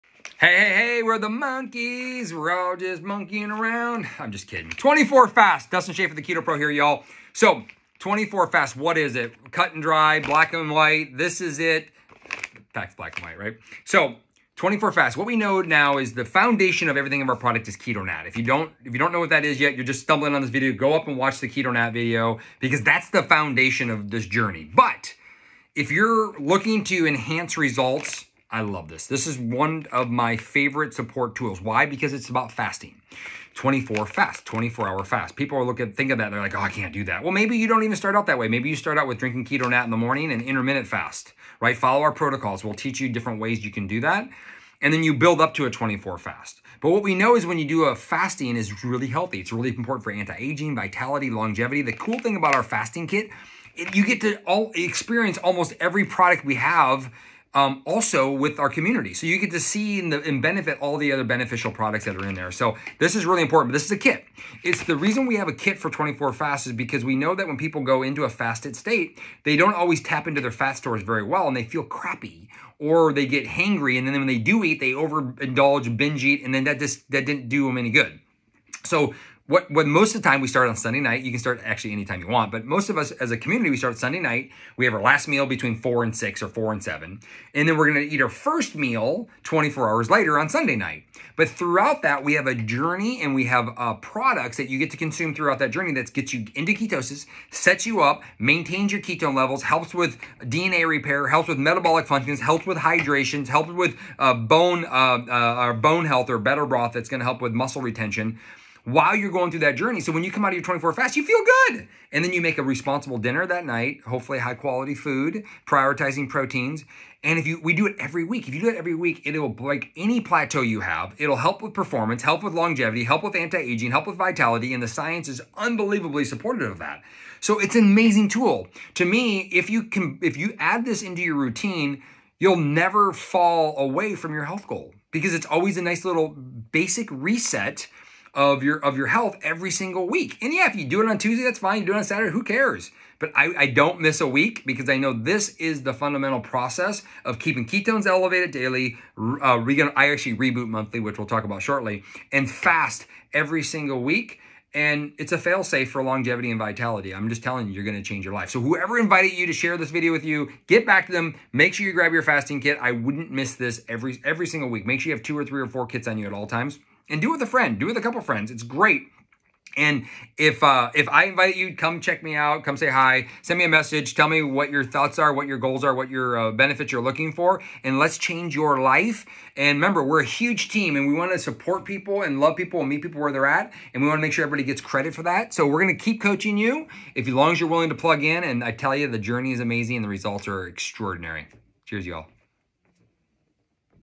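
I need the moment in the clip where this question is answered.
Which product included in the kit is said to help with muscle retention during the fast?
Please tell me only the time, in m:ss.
1:46.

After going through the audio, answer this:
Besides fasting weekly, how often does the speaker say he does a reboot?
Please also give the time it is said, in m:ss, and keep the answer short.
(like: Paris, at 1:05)
Monthly, at 2:30.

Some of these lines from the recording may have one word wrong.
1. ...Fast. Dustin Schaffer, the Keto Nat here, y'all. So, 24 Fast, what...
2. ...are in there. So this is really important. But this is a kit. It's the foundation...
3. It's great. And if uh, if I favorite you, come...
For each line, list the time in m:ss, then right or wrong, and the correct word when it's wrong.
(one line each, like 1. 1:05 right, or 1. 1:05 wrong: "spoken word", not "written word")
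1. 0:05 wrong: "Pro", not "Nat"
2. 1:02 wrong: "reason", not "foundation"
3. 2:48 wrong: "invite", not "favorite".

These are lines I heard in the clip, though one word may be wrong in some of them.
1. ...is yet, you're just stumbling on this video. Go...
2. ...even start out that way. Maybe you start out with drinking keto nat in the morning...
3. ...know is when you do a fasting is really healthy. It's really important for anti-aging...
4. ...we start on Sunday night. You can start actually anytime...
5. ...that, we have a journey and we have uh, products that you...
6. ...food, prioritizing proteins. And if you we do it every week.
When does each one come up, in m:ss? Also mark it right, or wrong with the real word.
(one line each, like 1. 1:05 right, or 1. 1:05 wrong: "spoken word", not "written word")
1. 0:19 right
2. 0:37 right
3. 0:47 right
4. 1:20 right
5. 1:32 right
6. 1:54 right.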